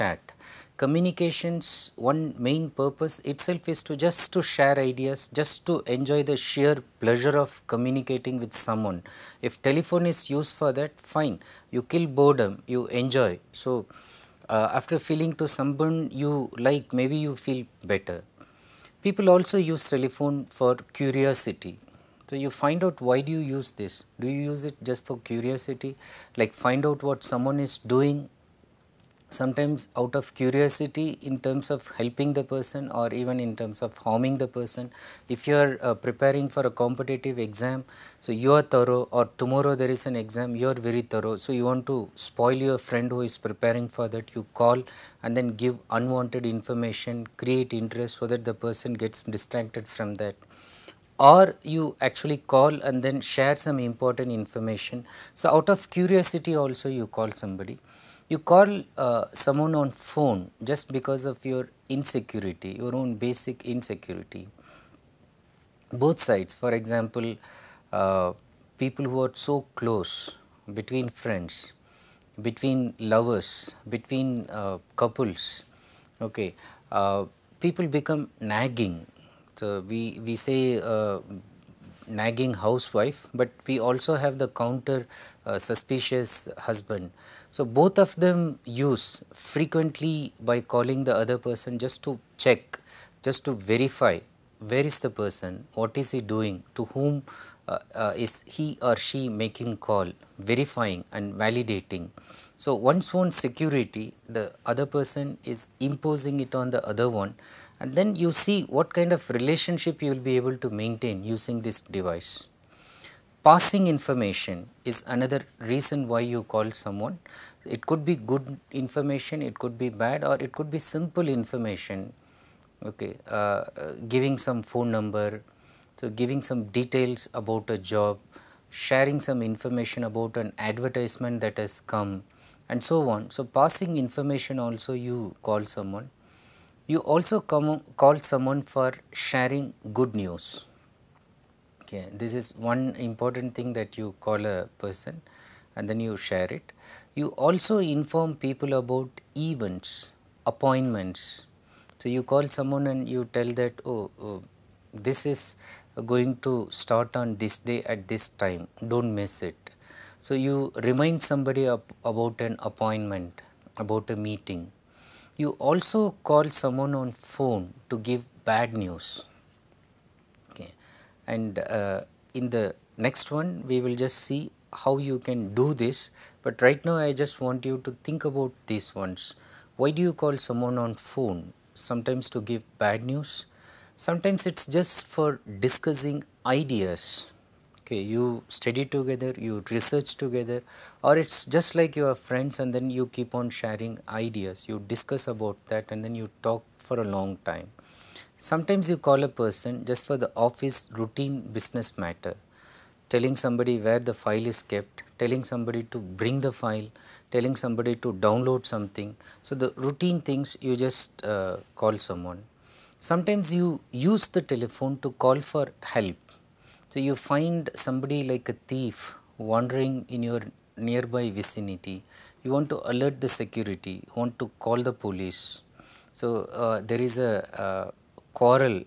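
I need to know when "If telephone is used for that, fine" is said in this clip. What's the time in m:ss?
0:09.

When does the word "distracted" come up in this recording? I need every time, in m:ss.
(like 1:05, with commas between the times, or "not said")
0:49.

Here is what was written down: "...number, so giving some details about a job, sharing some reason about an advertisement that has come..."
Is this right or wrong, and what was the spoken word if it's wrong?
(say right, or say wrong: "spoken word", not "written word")
wrong: "information", not "reason".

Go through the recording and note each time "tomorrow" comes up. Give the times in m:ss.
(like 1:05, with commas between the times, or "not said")
0:39.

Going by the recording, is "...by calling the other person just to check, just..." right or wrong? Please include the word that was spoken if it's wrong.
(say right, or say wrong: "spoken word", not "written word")
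right.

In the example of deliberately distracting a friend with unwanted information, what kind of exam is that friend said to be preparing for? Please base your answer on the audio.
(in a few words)
competitive exam.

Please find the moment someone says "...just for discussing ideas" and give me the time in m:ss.
3:04.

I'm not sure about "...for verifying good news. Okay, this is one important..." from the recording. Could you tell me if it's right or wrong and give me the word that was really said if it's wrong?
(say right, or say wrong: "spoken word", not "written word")
wrong: "sharing", not "verifying".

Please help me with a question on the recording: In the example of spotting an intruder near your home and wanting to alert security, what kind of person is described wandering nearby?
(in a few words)
a thief.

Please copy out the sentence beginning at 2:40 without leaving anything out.
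So, you remind somebody about an appointment, about a meeting.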